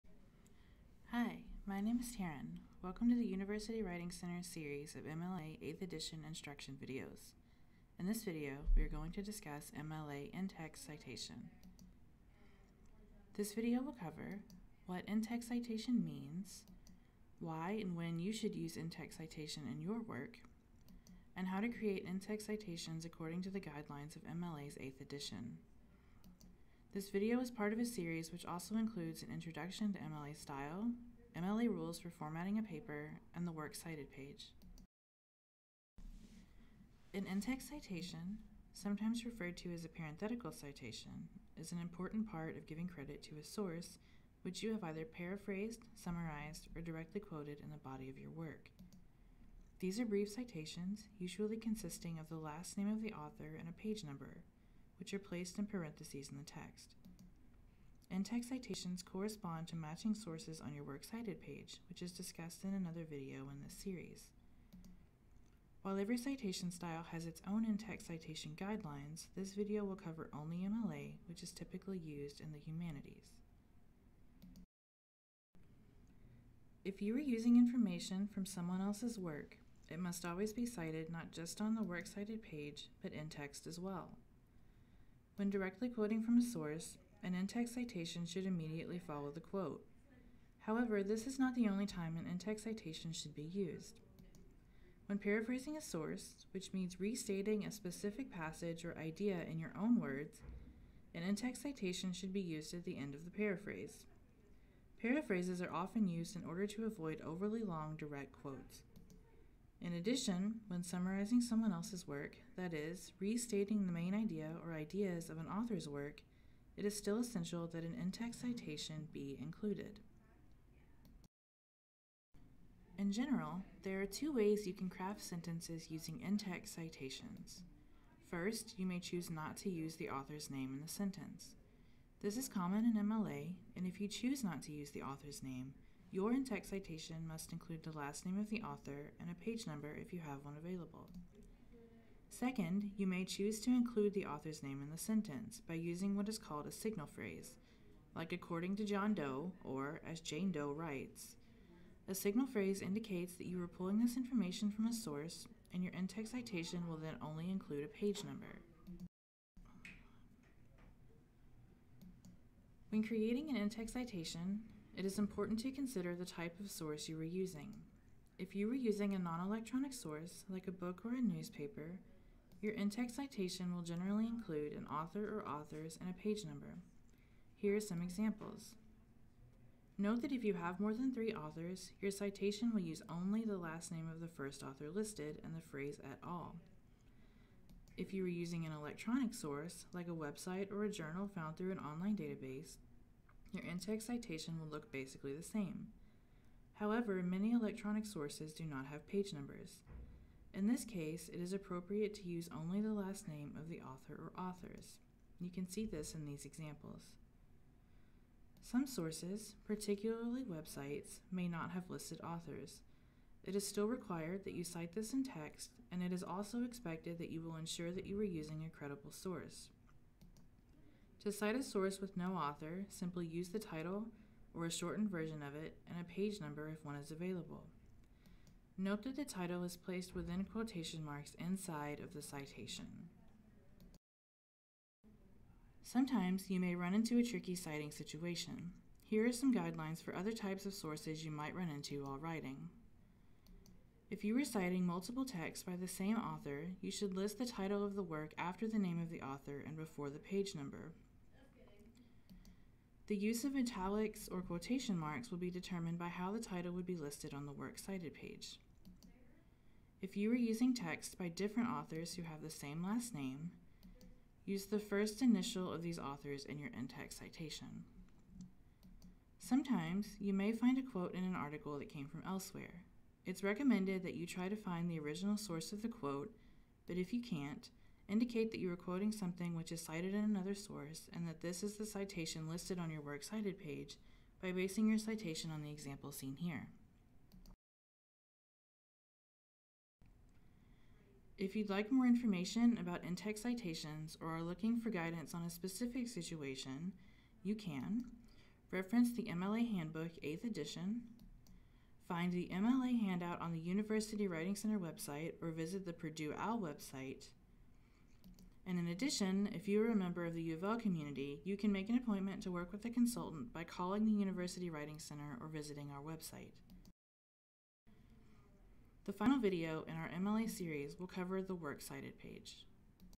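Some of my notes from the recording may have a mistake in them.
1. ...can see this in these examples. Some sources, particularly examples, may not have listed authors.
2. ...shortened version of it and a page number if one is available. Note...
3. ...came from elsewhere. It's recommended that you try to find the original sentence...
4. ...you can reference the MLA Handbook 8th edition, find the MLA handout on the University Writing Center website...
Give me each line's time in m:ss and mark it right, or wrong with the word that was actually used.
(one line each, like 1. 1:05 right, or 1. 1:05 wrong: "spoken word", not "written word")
1. 3:25 wrong: "websites", not "examples"
2. 3:44 right
3. 4:31 wrong: "source", not "sentence"
4. 4:57 right.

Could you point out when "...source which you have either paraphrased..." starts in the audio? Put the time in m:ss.
0:43.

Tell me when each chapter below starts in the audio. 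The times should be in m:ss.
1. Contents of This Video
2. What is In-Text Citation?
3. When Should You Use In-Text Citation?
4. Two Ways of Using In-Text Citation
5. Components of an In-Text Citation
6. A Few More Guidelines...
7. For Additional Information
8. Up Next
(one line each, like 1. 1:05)
1. 0:12
2. 0:36
3. 1:15
4. 2:02
5. 2:39
6. 3:55
7. 4:50
8. 5:18.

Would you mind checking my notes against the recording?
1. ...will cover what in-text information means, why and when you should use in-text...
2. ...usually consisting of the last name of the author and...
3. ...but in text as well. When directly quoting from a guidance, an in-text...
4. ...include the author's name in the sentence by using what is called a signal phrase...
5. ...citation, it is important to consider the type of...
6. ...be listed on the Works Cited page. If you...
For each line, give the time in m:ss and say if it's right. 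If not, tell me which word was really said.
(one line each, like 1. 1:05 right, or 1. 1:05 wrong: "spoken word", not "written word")
1. 0:13 wrong: "citation", not "information"
2. 0:51 right
3. 1:23 wrong: "source", not "guidance"
4. 2:23 right
5. 2:43 right
6. 4:16 right.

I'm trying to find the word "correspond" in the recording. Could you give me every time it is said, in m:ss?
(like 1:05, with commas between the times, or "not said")
0:59.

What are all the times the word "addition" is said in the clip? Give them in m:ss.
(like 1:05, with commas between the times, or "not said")
1:49, 5:08.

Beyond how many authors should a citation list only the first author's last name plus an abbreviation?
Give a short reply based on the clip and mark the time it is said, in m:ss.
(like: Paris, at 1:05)
3, at 3:01.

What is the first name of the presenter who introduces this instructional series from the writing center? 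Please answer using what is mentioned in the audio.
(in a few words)
Taryn.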